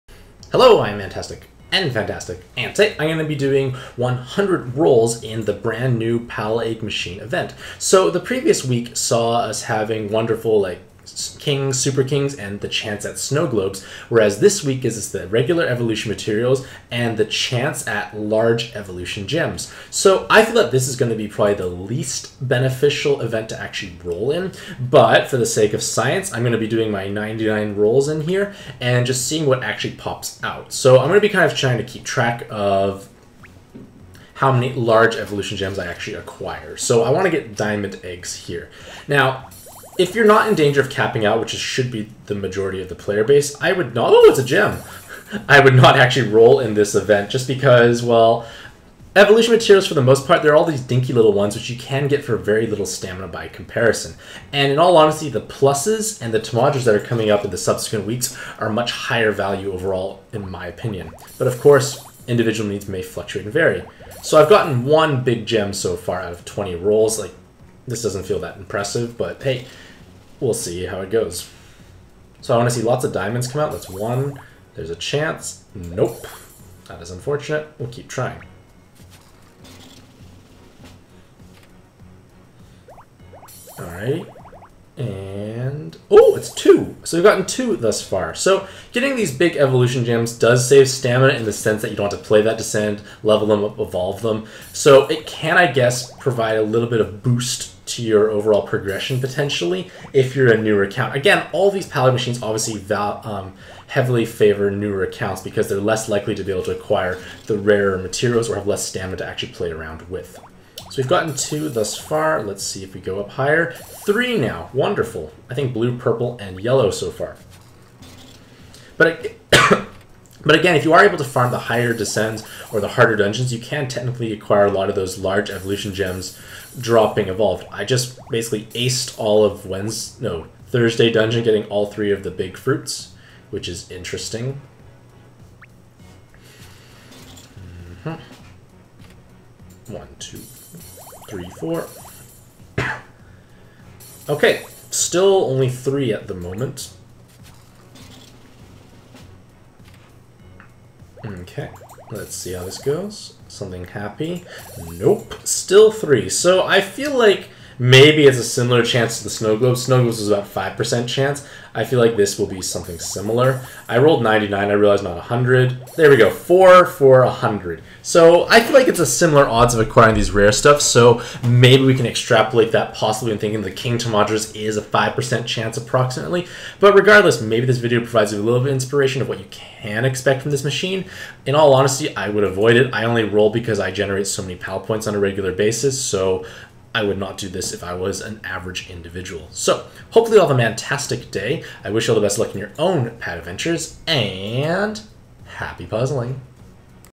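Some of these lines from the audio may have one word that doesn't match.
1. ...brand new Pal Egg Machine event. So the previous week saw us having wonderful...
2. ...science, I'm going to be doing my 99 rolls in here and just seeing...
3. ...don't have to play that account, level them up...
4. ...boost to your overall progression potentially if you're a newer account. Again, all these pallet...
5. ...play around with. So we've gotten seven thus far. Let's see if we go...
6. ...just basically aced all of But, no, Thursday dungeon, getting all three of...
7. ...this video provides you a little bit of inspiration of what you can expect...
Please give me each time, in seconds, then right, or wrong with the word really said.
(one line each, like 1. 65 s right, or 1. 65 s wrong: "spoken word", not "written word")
1. 5 s right
2. 25 s right
3. 91 s wrong: "descent", not "account"
4. 97 s right
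5. 109 s wrong: "two", not "seven"
6. 127 s wrong: "Wednesday", not "But"
7. 177 s right.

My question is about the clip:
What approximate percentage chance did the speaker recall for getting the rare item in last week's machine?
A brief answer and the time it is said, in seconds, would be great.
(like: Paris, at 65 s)
5%, at 160 s.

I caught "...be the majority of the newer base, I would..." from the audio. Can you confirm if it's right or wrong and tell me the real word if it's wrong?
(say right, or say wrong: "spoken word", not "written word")
wrong: "player", not "newer".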